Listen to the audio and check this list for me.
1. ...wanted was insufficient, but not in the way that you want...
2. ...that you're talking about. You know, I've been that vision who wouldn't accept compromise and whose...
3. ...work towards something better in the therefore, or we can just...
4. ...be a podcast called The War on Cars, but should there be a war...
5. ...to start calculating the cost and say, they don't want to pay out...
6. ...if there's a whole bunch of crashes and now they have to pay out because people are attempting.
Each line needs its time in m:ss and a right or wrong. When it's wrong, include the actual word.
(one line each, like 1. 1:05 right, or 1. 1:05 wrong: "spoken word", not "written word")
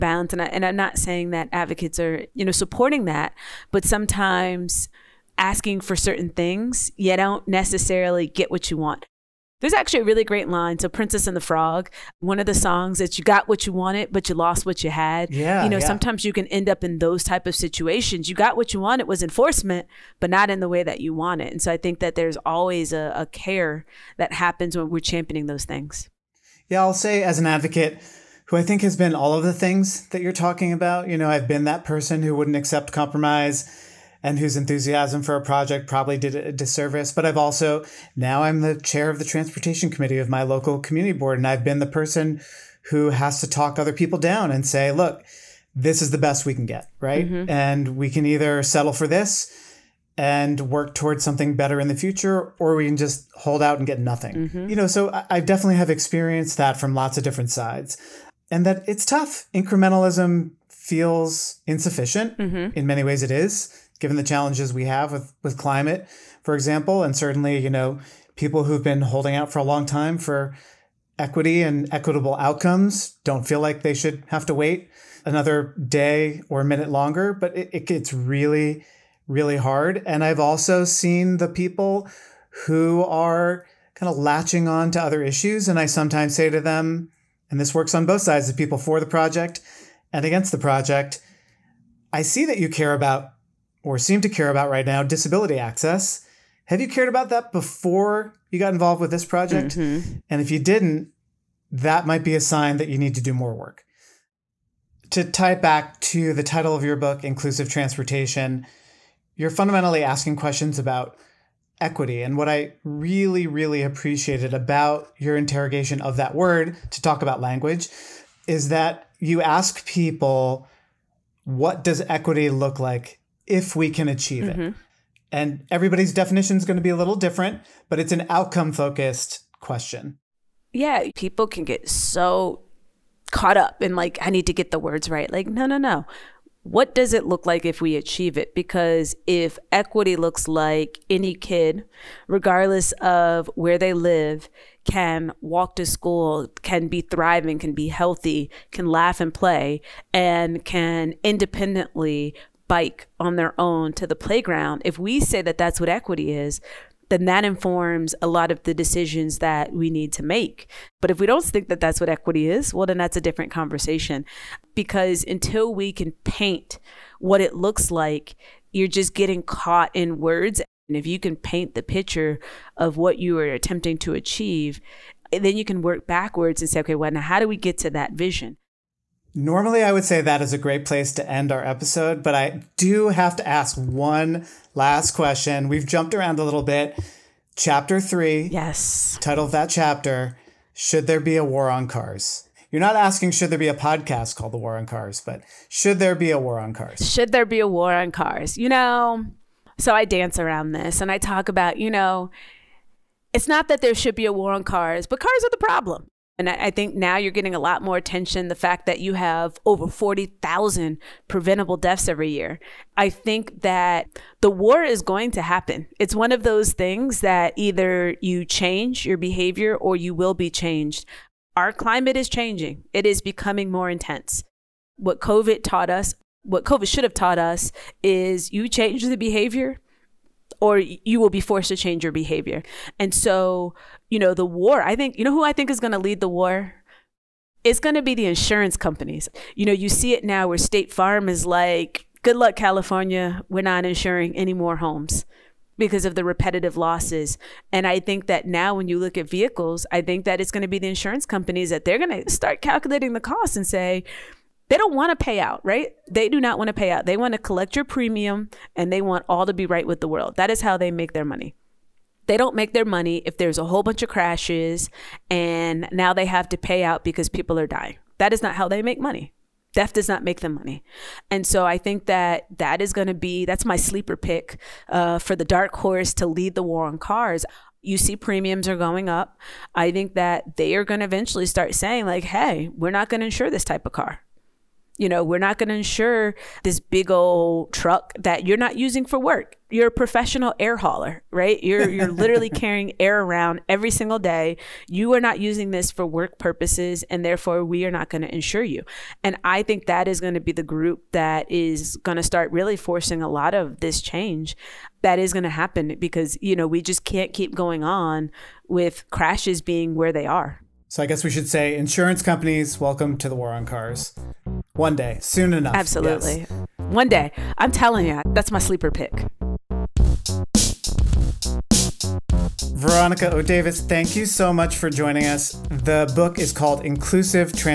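1. 0:18 wrong: "enforcement", not "insufficient"
2. 0:30 wrong: "person", not "vision"
3. 0:50 wrong: "future", not "therefore"
4. 3:13 right
5. 4:12 right
6. 4:23 wrong: "dying", not "attempting".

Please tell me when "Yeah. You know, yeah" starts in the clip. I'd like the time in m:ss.
0:15.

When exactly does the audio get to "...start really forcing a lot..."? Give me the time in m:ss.
5:02.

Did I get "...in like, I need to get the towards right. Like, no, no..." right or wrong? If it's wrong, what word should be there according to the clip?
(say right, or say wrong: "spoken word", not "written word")
wrong: "words", not "towards".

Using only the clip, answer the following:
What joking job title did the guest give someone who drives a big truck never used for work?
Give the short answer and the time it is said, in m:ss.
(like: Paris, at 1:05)
professional air hauler, at 4:49.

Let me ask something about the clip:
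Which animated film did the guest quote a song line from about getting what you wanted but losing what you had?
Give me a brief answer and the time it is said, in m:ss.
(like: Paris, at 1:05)
Princess and the Frog, at 0:10.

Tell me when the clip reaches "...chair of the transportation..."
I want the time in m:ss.
0:38.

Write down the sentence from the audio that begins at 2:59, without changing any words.
Normally, I would say that is a great place to end our episode, but I do have to ask one last question.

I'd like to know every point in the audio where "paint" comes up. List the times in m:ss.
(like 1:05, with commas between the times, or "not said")
2:46, 2:51.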